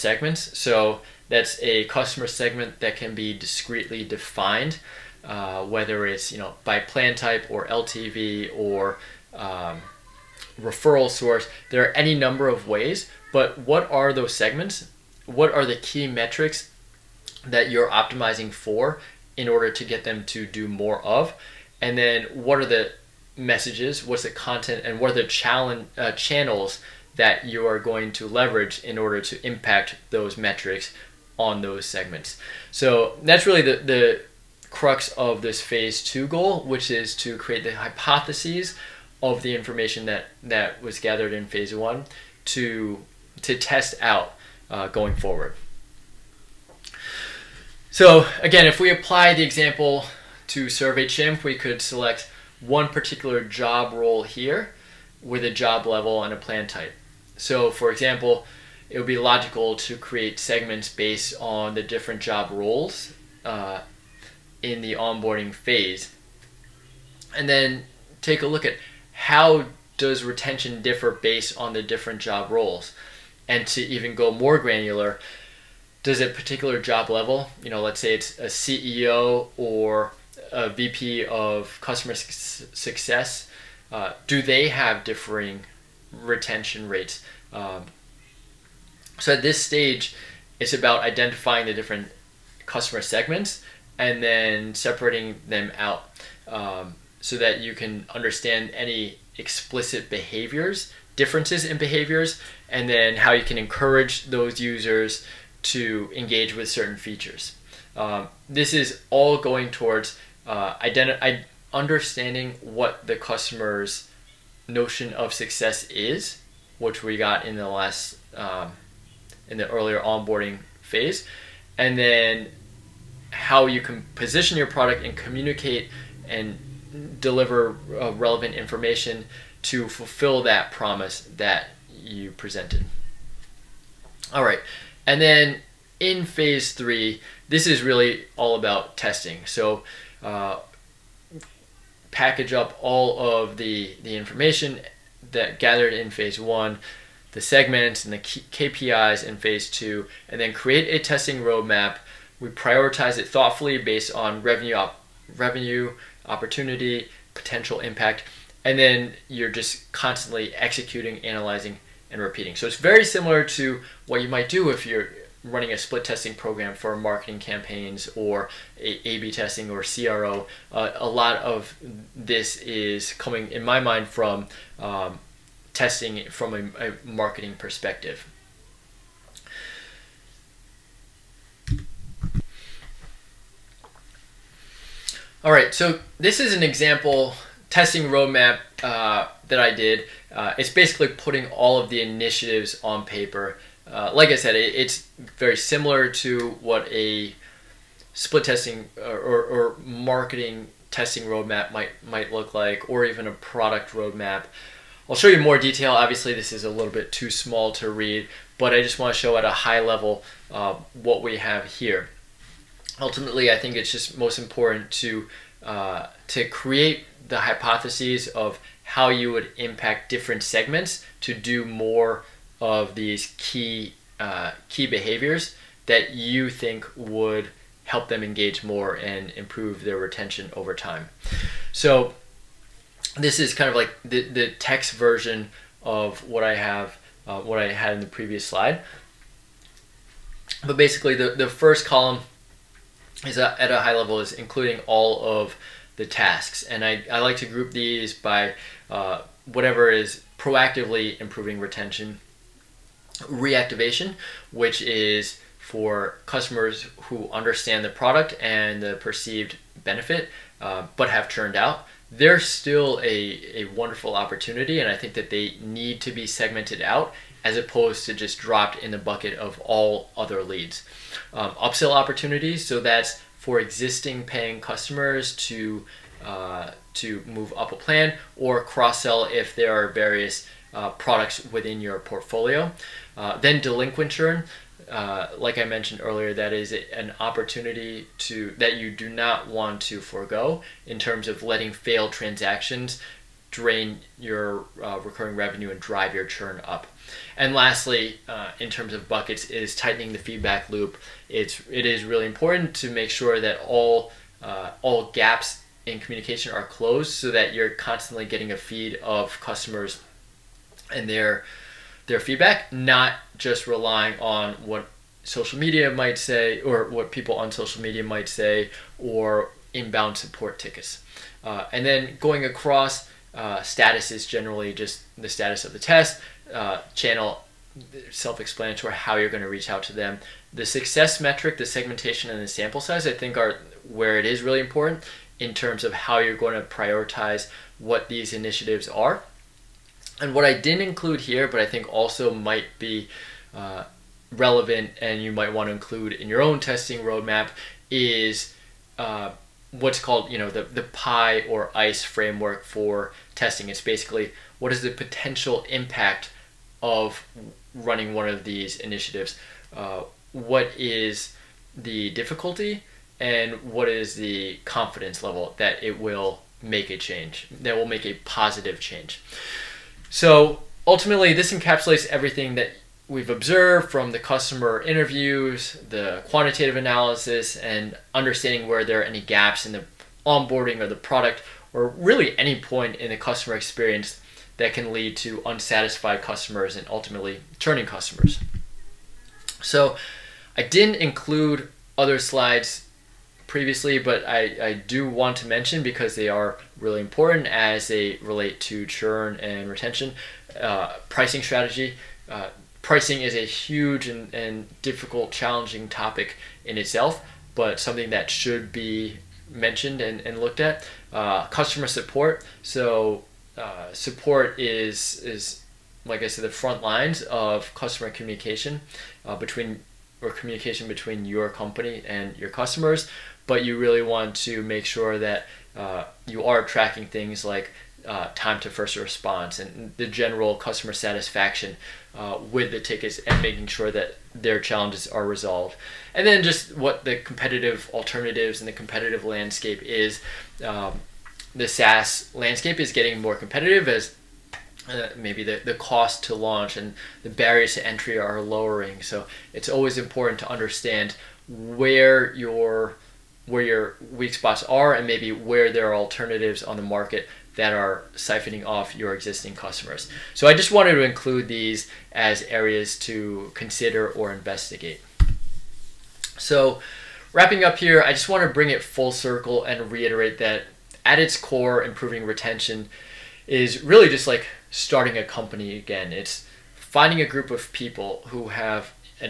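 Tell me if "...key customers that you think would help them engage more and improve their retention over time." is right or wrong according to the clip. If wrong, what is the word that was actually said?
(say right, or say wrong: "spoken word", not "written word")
wrong: "behaviors", not "customers".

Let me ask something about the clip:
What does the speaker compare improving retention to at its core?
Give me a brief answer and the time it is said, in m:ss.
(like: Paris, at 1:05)
Starting a company, at 7:54.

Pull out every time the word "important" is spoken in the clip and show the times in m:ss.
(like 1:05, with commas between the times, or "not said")
3:34, 5:02, 5:34, 6:36, 7:29.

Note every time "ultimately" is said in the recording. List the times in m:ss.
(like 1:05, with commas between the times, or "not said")
3:32, 6:10, 6:26.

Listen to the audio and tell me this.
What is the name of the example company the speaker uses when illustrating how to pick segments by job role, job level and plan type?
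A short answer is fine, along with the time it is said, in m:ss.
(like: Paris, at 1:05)
SurveyChimp, at 0:50.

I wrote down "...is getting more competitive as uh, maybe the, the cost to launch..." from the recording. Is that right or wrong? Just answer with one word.
right.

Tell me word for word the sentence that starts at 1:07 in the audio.
And then take a look at how does retention differ based on the different job roles.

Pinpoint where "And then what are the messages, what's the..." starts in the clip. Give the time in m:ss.
0:21.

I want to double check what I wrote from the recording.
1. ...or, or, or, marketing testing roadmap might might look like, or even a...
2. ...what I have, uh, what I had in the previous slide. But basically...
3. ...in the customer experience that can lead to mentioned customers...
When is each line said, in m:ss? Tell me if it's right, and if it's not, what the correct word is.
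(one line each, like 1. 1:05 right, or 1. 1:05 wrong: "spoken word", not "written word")
1. 3:18 right
2. 3:56 right
3. 6:22 wrong: "unsatisfied", not "mentioned".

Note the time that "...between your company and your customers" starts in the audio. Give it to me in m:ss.
7:00.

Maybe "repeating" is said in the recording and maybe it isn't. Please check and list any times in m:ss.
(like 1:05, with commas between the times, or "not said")
2:42.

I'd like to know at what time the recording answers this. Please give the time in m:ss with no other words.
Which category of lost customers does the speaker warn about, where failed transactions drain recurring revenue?
4:43.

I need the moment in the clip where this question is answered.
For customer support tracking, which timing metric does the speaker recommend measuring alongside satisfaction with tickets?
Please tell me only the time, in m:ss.
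7:08.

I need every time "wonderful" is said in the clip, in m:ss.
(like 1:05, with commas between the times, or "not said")
4:23.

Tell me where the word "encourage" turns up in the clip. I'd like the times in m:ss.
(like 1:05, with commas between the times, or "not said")
1:43.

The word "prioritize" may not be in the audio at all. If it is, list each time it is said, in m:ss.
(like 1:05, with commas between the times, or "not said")
2:32, 5:36.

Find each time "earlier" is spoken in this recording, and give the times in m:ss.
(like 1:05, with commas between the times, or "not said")
1:59, 4:46.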